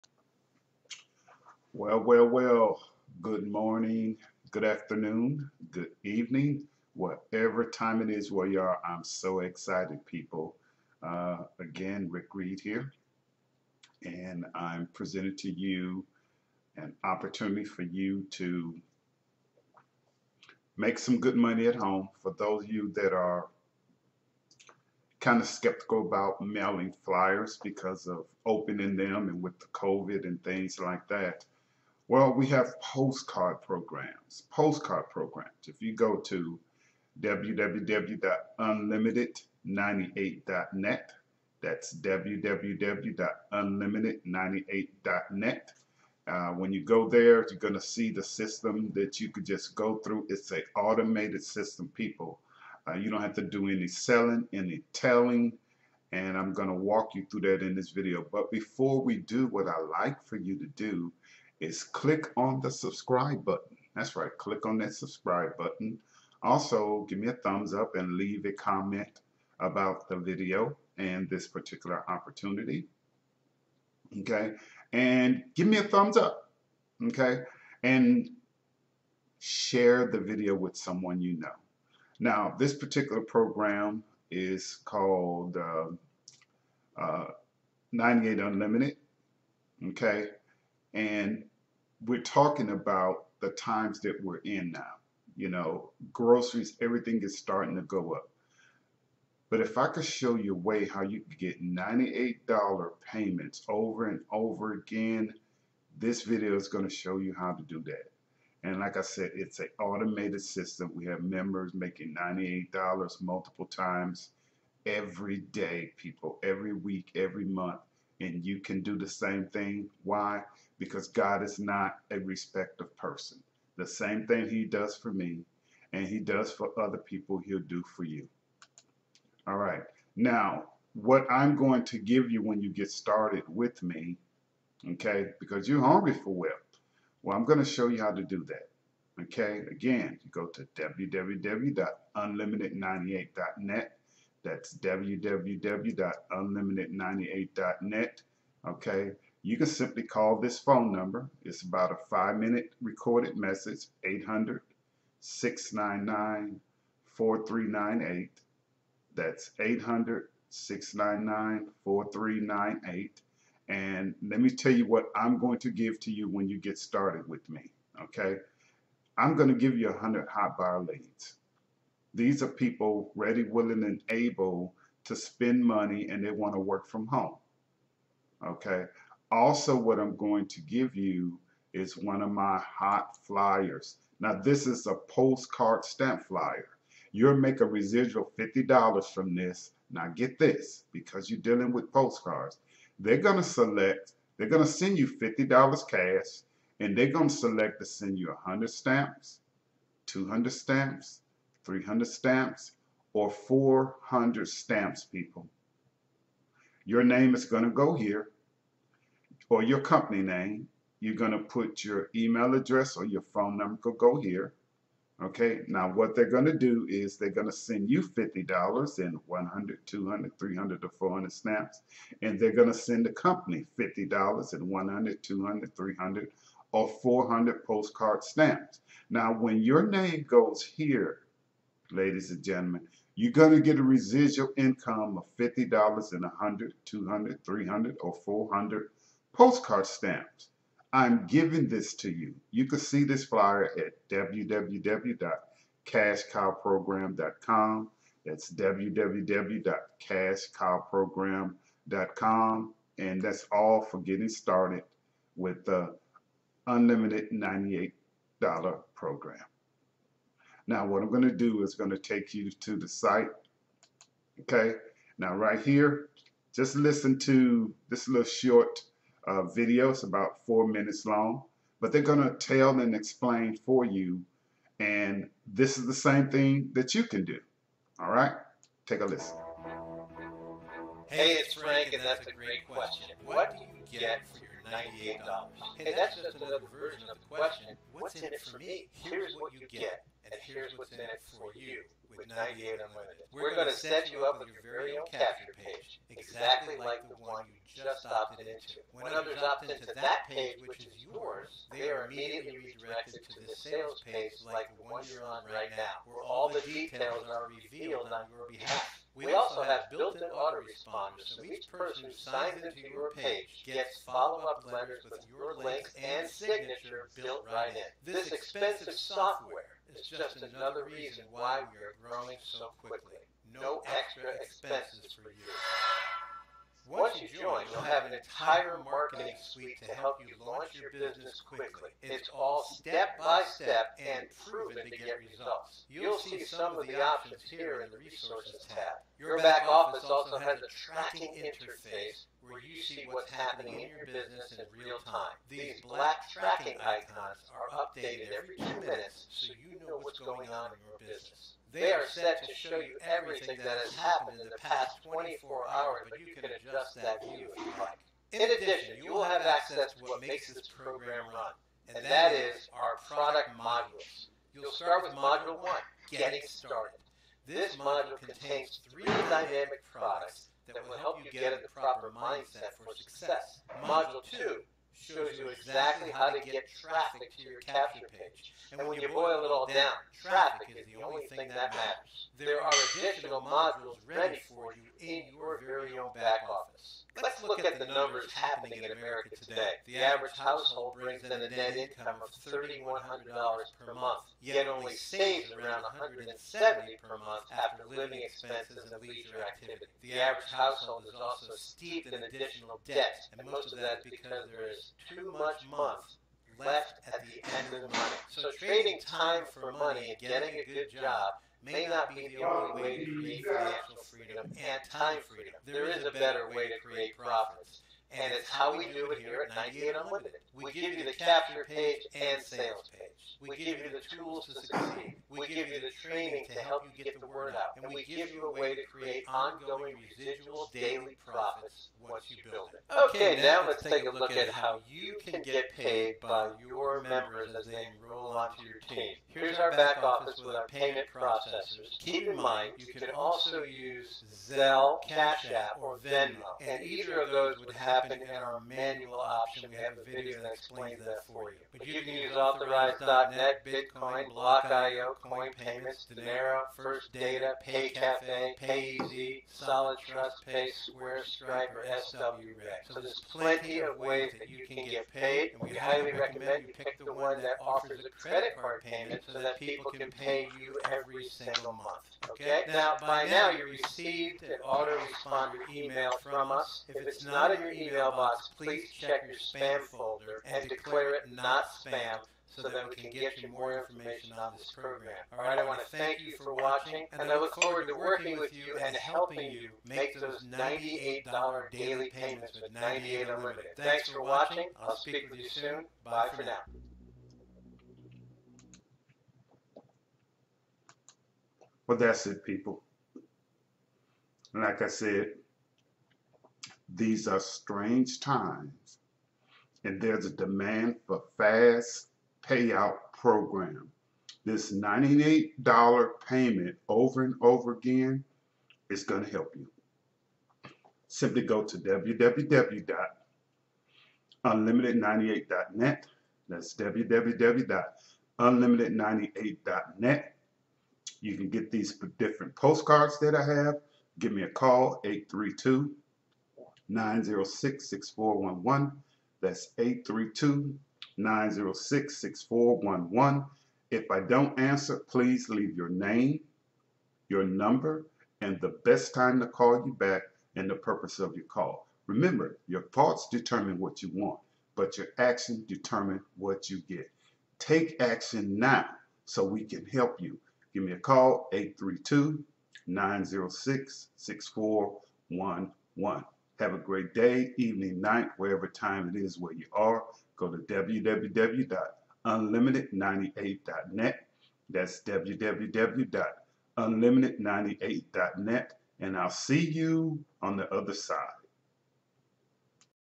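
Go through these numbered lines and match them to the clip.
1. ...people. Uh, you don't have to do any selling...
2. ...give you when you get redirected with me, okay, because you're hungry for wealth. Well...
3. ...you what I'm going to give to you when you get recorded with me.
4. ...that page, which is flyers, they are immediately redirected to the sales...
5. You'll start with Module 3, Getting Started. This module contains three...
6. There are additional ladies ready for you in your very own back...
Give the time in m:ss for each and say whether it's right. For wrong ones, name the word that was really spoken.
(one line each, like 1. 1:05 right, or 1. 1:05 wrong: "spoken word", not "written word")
1. 0:51 right
2. 2:11 wrong: "started", not "redirected"
3. 2:44 wrong: "started", not "recorded"
4. 4:59 wrong: "yours", not "flyers"
5. 6:04 wrong: "1", not "3"
6. 6:22 wrong: "modules", not "ladies".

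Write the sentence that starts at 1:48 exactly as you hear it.
And like I said, it's an automated system.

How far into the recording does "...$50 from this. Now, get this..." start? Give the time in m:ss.
3:08.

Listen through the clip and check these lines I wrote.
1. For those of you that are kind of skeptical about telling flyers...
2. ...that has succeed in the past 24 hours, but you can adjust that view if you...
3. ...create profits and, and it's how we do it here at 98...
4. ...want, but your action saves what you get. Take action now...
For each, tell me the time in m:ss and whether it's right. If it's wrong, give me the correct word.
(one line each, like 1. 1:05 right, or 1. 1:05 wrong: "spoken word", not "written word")
1. 0:22 wrong: "mailing", not "telling"
2. 5:53 wrong: "happened", not "succeed"
3. 6:56 right
4. 9:14 wrong: "determines", not "saves".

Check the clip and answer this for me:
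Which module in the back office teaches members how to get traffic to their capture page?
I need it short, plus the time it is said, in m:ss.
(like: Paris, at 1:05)
Module 2, at 6:13.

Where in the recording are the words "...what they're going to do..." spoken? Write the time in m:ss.
3:35.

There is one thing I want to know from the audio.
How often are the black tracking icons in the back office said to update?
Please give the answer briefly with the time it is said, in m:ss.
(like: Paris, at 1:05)
every two minutes, at 5:48.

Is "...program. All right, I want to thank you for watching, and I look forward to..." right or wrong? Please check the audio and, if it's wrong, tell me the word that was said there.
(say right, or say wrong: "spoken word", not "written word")
right.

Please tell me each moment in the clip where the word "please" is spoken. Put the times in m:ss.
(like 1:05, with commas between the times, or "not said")
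7:58, 9:05.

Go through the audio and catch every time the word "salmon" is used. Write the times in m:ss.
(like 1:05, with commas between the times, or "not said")
not said.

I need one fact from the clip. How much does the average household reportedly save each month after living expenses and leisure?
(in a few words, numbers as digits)
$170.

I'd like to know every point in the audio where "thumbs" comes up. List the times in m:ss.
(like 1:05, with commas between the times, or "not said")
1:07, 1:15.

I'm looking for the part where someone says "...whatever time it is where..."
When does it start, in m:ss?
0:06.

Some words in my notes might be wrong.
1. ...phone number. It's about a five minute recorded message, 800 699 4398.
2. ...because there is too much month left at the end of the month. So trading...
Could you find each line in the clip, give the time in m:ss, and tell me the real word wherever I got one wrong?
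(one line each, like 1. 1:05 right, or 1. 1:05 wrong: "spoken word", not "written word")
1. 2:30 right
2. 6:44 right.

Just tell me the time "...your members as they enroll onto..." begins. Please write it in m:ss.
7:16.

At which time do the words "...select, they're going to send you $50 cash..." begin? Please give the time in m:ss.
3:13.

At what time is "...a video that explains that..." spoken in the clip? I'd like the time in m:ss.
7:30.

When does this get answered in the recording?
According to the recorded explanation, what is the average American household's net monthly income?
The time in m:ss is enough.
6:32.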